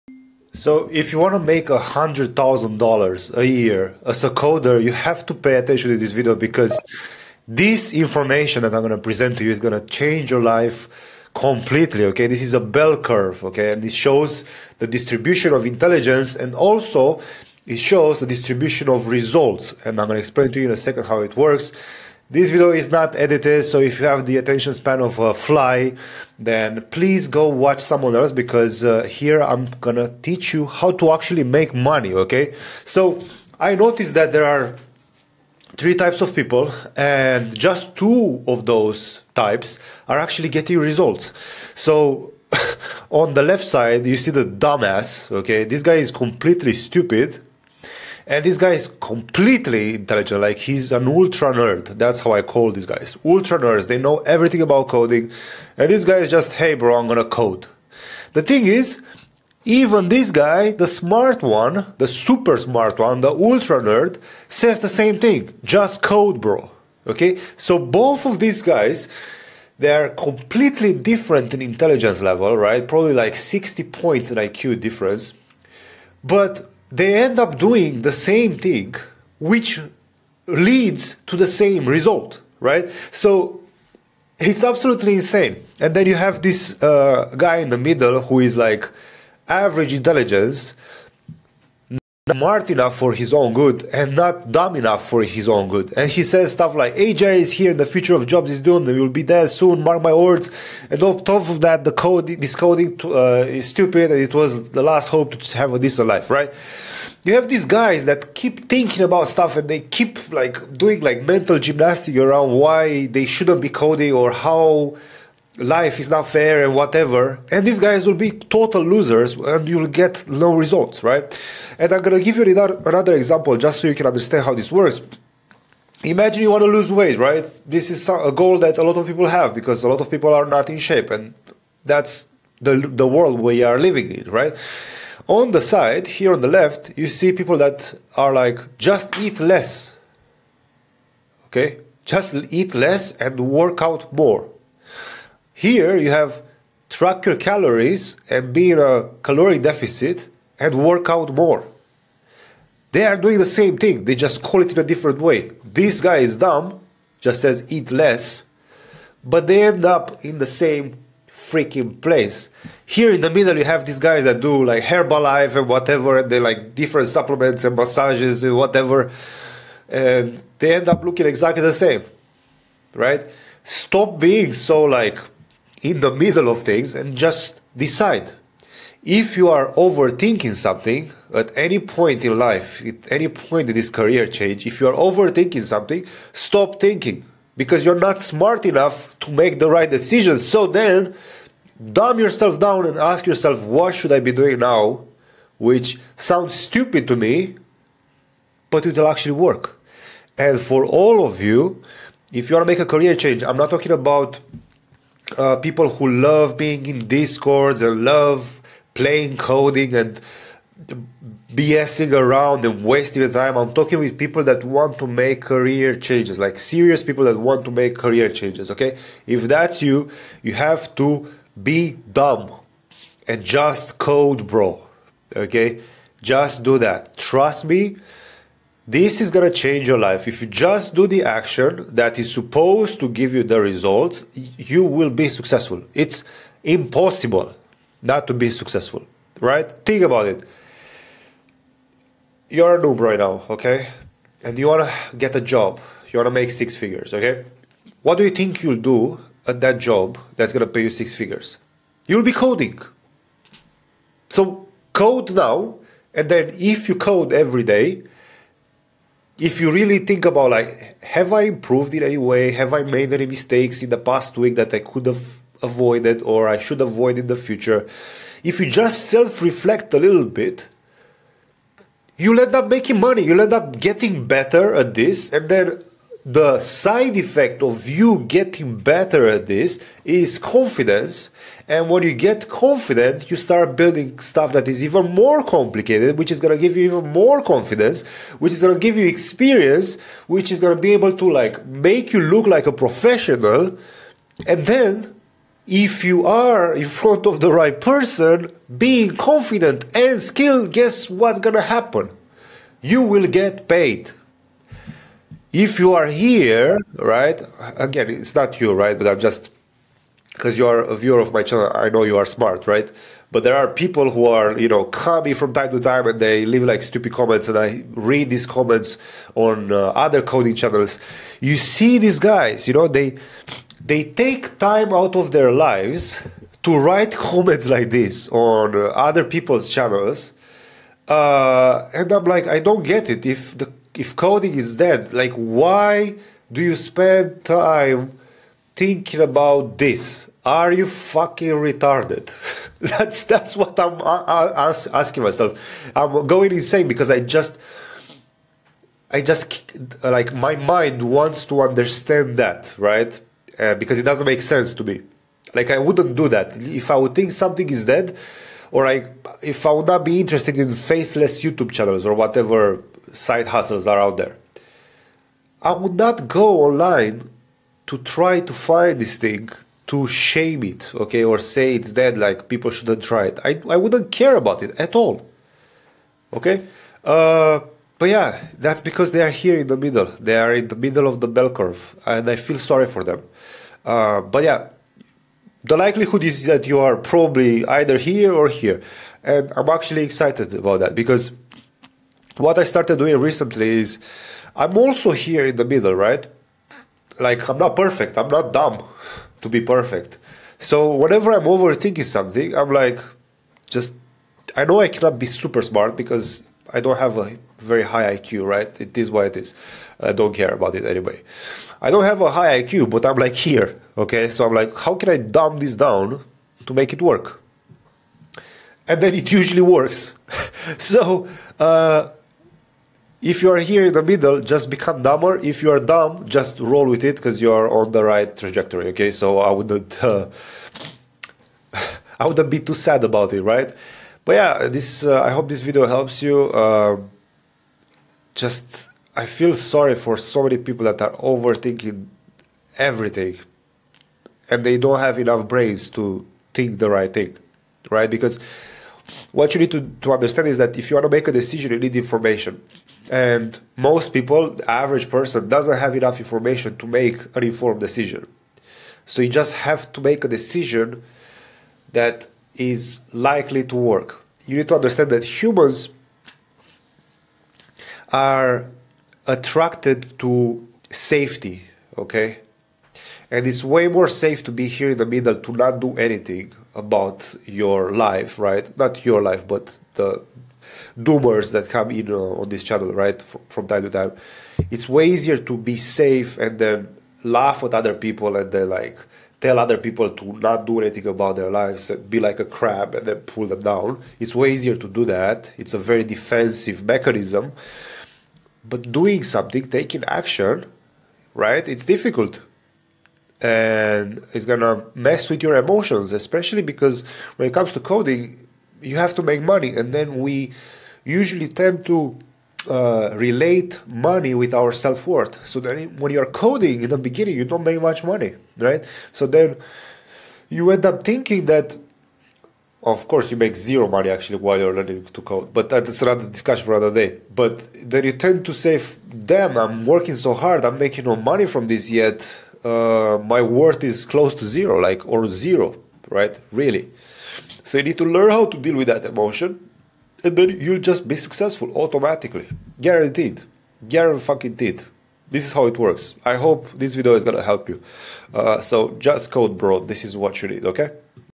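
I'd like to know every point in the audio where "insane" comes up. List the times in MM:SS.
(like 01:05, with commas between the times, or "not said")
01:25, 05:46.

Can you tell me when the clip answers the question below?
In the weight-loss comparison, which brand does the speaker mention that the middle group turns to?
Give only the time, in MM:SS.
02:44.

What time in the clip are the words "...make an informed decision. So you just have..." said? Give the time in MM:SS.
07:36.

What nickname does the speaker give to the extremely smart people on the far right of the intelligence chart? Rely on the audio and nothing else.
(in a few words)
Ultra nerds.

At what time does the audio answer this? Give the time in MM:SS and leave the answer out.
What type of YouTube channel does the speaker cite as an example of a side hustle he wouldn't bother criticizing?
06:00.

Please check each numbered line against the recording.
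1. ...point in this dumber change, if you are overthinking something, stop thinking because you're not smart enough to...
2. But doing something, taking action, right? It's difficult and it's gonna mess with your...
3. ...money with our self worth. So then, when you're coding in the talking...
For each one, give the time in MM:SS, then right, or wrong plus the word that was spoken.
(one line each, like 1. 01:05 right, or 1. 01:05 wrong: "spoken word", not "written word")
1. 03:03 wrong: "career", not "dumber"
2. 08:18 right
3. 08:33 wrong: "beginning", not "talking".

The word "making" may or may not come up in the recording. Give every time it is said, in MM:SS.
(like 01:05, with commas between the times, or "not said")
04:32, 08:50.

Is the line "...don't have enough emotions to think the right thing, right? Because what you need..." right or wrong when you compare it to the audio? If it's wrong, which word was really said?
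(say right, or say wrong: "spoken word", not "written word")
wrong: "brains", not "emotions".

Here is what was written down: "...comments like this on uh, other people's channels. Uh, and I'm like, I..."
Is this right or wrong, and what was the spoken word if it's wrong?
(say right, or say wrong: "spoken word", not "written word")
right.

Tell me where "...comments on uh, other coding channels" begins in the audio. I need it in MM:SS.
05:18.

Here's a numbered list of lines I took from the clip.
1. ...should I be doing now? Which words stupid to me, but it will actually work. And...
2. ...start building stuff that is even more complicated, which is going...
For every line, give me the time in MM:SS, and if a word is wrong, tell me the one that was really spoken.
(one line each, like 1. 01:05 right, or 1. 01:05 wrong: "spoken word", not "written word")
1. 03:13 wrong: "sounds", not "words"
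2. 04:43 right.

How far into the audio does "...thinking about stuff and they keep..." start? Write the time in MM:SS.
01:48.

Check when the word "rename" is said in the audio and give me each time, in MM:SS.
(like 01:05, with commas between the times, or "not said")
not said.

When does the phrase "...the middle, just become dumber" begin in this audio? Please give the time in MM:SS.
07:03.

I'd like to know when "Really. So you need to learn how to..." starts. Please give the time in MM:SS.
08:56.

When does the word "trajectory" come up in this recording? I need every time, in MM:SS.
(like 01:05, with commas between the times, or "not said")
07:08.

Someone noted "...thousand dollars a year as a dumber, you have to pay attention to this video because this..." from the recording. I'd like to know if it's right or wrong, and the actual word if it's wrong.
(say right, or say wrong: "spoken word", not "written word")
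wrong: "coder", not "dumber".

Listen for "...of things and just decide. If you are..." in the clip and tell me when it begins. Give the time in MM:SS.
02:56.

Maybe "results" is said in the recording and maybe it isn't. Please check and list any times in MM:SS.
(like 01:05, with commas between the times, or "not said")
00:19, 00:40, 01:21, 02:00, 03:53.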